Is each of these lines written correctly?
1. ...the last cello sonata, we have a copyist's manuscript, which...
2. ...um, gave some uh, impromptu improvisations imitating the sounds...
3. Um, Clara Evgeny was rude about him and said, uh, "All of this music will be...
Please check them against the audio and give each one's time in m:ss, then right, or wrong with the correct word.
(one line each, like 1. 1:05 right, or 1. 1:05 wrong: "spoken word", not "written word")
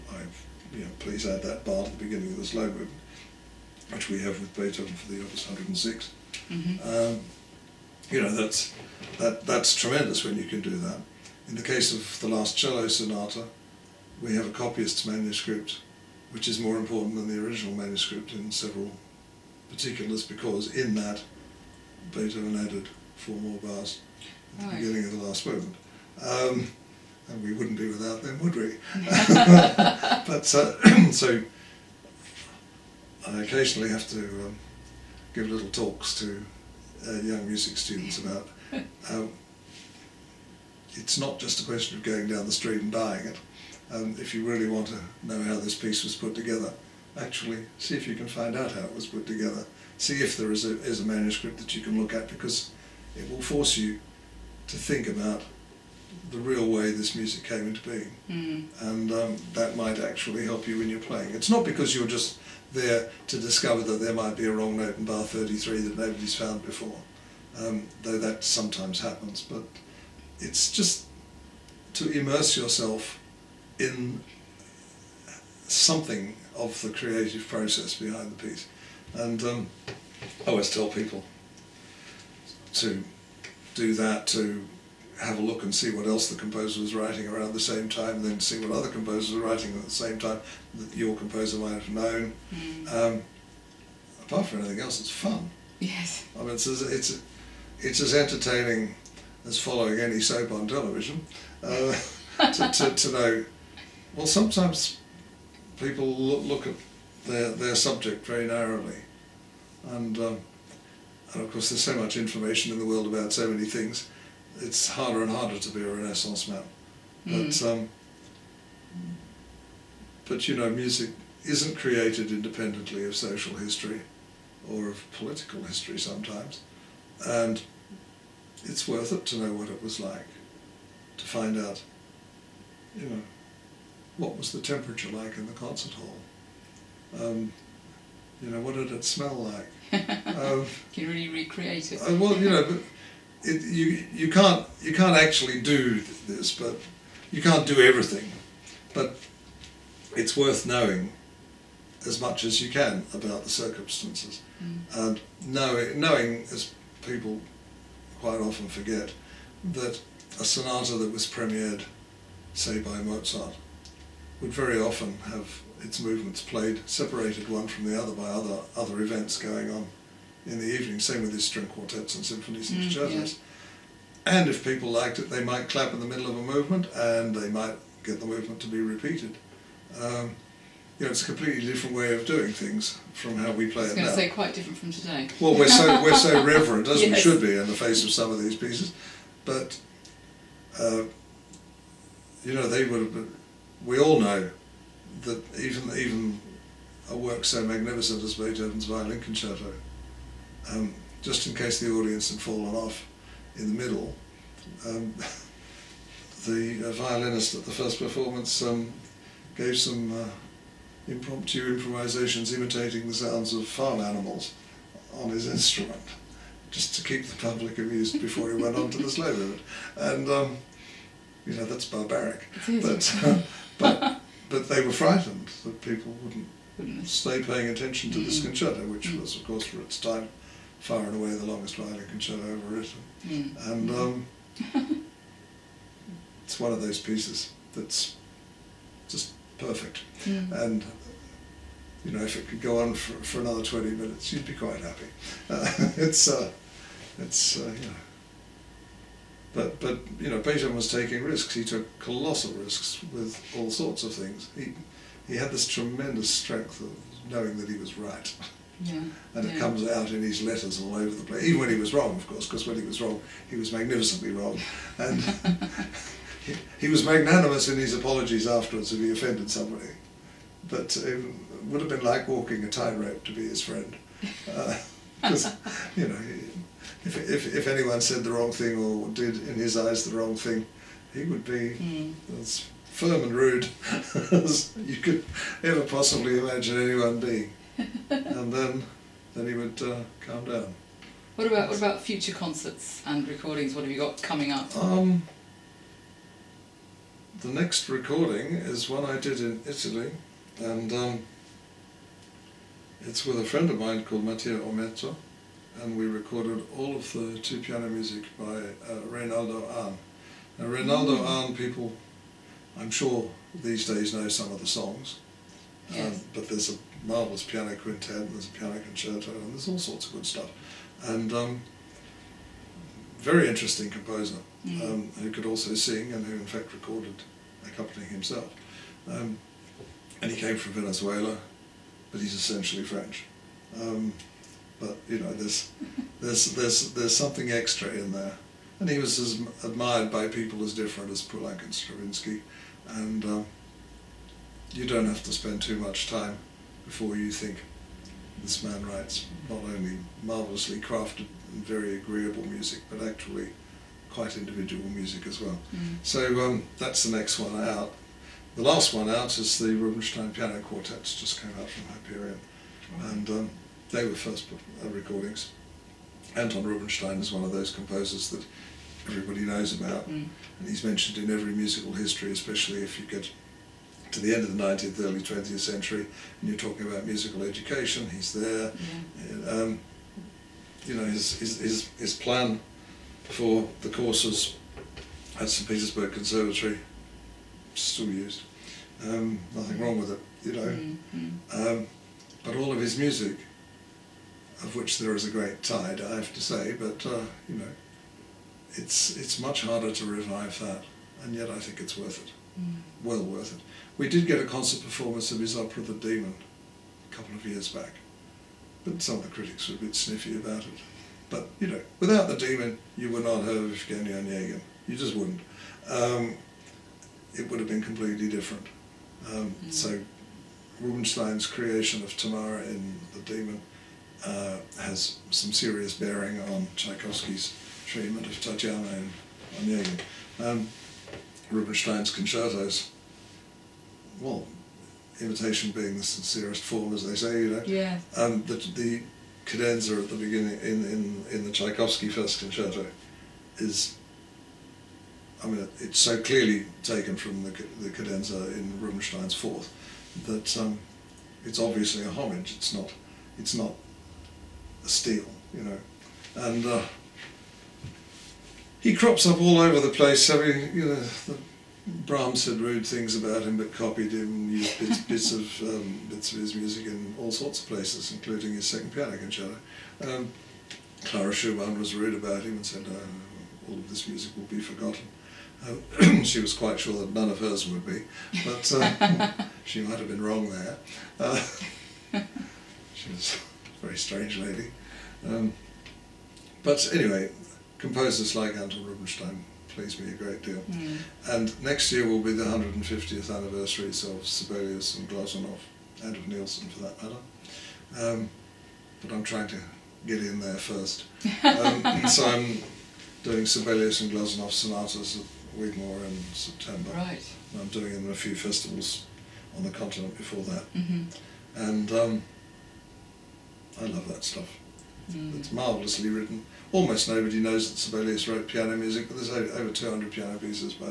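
1. 0:12 right
2. 3:28 right
3. 7:50 wrong: "Schumann", not "Evgeny".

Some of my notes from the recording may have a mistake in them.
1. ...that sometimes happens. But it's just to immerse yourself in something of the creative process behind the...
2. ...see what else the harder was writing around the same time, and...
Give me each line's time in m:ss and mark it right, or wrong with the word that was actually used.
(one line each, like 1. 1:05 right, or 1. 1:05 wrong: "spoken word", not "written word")
1. 1:08 right
2. 1:25 wrong: "composer", not "harder".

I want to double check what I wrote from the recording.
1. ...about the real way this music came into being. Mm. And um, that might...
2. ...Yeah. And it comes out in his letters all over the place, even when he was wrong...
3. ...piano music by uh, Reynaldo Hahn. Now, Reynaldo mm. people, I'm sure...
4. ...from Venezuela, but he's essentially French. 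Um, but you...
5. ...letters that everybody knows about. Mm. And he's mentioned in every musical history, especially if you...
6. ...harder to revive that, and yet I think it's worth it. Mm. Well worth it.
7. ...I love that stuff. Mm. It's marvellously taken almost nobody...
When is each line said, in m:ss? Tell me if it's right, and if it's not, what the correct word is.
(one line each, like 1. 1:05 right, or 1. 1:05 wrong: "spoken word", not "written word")
1. 0:55 right
2. 4:18 right
3. 5:07 right
4. 5:30 right
5. 6:07 wrong: "composers", not "letters"
6. 6:39 right
7. 8:33 wrong: "written", not "taken".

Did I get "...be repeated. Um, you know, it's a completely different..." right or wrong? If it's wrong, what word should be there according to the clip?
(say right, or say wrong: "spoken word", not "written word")
right.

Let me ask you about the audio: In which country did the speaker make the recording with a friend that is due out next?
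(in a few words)
Italy.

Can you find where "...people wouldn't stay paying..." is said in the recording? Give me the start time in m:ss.
3:45.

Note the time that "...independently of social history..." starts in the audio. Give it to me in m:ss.
2:02.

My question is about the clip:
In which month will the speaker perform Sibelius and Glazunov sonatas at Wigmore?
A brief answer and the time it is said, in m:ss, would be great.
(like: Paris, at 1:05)
September, at 8:26.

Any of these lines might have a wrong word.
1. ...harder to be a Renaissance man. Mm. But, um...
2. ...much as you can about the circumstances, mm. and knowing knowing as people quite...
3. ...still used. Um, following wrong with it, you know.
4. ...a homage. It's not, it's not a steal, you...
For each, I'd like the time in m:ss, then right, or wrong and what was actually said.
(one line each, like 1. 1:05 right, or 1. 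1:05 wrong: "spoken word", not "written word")
1. 1:55 right
2. 2:32 right
3. 6:27 wrong: "nothing", not "following"
4. 7:32 right.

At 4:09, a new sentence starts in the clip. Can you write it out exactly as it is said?
But, but, you know, Beethoven was taking risks.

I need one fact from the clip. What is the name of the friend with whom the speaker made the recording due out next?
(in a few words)
Matteo Ometto.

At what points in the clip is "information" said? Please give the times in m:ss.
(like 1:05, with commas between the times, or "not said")
1:52.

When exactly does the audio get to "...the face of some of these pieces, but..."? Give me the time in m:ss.
3:07.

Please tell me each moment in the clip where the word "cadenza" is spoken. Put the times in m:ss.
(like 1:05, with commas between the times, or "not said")
7:19, 7:27.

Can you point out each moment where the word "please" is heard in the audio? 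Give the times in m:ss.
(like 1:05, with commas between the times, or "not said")
0:00, 8:09.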